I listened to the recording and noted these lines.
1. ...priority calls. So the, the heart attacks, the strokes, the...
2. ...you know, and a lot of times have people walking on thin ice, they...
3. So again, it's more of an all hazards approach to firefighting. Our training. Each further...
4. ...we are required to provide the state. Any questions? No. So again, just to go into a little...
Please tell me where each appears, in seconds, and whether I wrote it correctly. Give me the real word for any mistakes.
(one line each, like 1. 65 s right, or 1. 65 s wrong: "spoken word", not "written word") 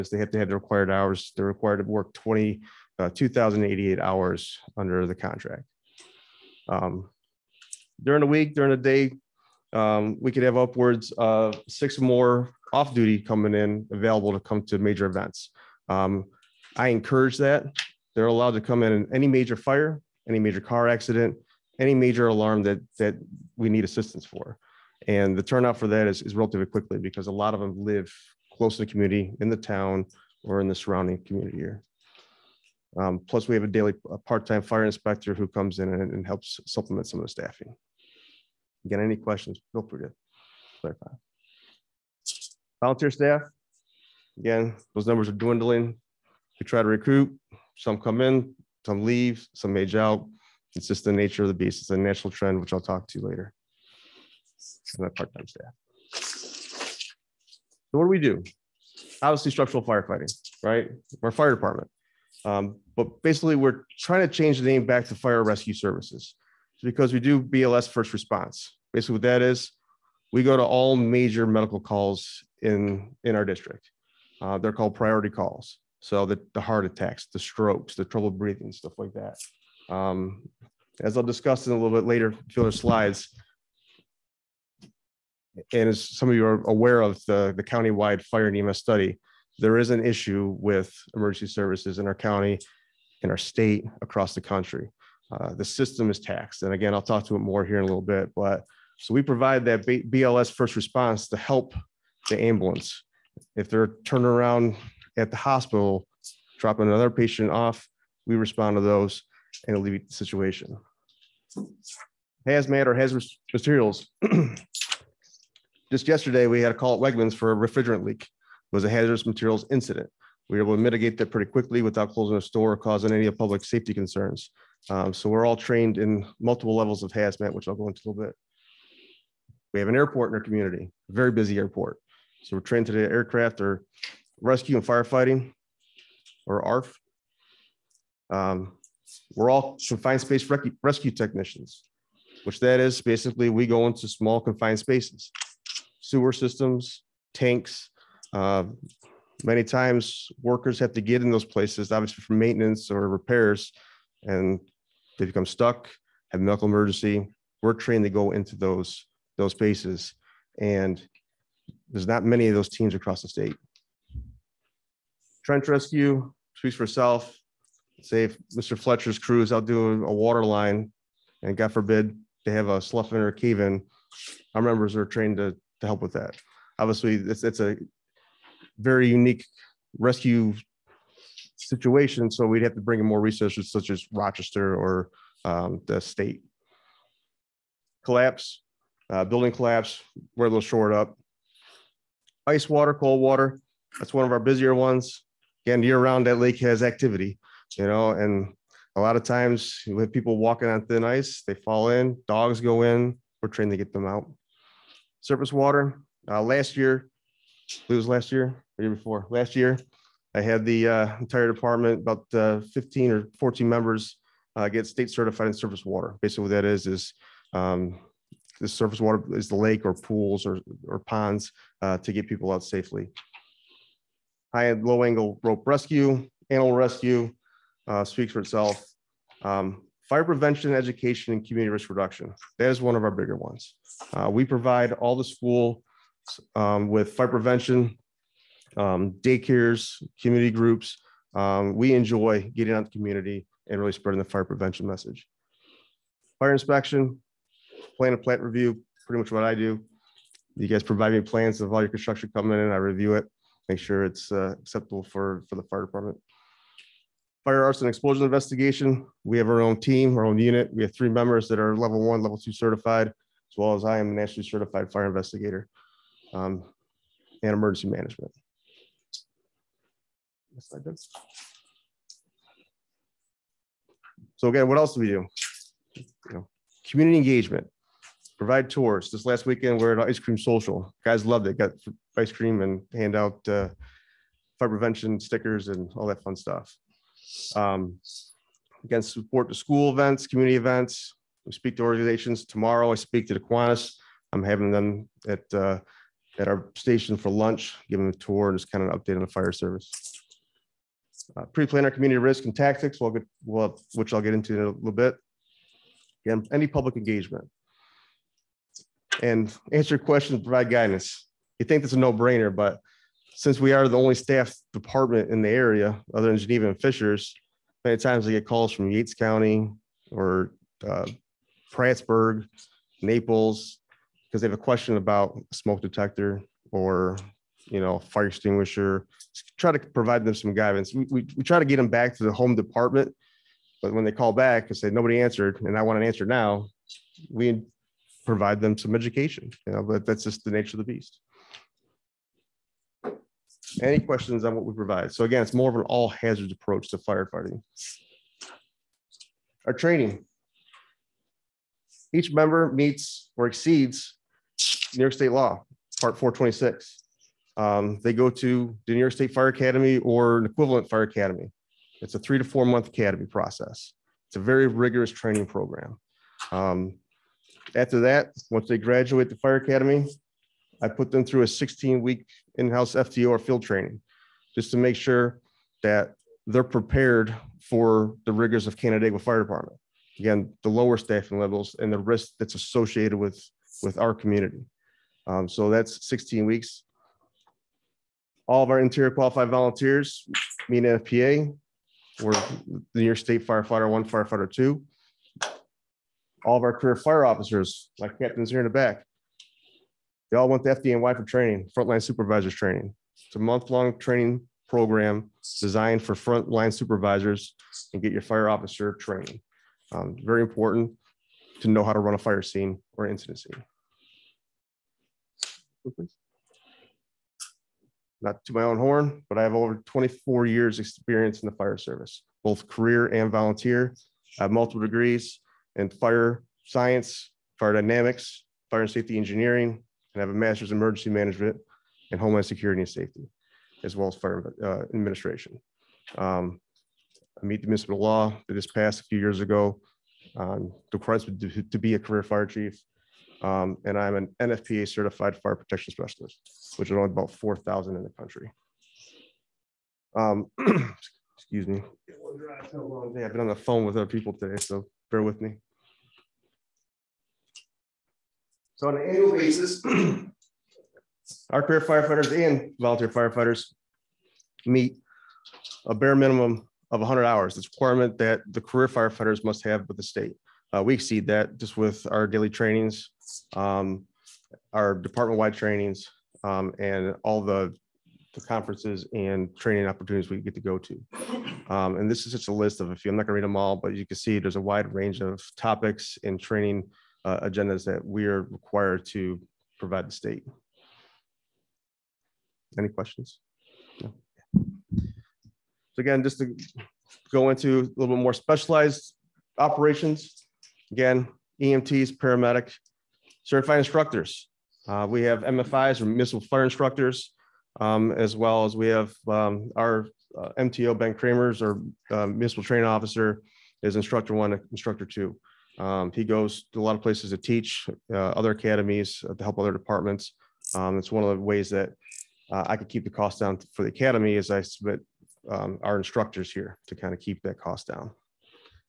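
1. 74 s right
2. 197 s right
3. 345 s wrong: "member", not "further"
4. 488 s right.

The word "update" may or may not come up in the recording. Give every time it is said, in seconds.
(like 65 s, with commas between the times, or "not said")
298 s.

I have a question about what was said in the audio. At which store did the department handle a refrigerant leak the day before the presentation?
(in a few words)
Wegmans.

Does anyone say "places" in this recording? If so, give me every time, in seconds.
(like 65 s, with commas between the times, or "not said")
151 s, 517 s.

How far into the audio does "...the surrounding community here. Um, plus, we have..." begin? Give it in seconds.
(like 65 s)
30 s.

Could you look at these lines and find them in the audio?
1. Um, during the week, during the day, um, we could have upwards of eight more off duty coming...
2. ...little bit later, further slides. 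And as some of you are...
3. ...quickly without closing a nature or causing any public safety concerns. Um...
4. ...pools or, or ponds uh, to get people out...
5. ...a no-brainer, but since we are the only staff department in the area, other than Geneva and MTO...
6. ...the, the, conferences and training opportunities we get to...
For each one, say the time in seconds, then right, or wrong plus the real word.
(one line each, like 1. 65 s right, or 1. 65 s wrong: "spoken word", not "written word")
1. 6 s wrong: "six", not "eight"
2. 81 s right
3. 121 s wrong: "store", not "nature"
4. 219 s right
5. 311 s wrong: "Fishers", not "MTO"
6. 477 s right.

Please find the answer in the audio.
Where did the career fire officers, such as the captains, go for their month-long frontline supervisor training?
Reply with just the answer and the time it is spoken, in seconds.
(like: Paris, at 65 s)
FDNY, at 400 s.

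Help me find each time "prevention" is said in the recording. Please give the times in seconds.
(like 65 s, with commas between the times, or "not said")
230 s, 237 s, 244 s, 284 s.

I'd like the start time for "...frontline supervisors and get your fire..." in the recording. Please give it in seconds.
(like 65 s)
406 s.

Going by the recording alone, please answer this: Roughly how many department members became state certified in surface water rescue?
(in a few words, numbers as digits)
15.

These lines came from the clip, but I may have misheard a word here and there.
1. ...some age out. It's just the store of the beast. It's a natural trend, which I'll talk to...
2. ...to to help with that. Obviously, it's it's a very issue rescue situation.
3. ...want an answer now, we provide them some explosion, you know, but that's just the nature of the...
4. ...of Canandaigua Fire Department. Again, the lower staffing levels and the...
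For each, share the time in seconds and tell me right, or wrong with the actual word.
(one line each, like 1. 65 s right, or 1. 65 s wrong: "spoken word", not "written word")
1. 49 s wrong: "nature", not "store"
2. 175 s wrong: "unique", not "issue"
3. 335 s wrong: "education", not "explosion"
4. 378 s right.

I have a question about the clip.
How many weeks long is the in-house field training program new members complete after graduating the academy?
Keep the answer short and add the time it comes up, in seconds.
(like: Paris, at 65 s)
16, at 371 s.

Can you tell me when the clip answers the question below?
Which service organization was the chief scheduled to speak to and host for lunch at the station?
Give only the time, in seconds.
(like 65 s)
293 s.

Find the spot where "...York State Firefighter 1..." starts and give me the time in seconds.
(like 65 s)
393 s.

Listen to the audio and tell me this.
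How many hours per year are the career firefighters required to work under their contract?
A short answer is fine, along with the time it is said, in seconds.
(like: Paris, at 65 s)
2,088, at 3 s.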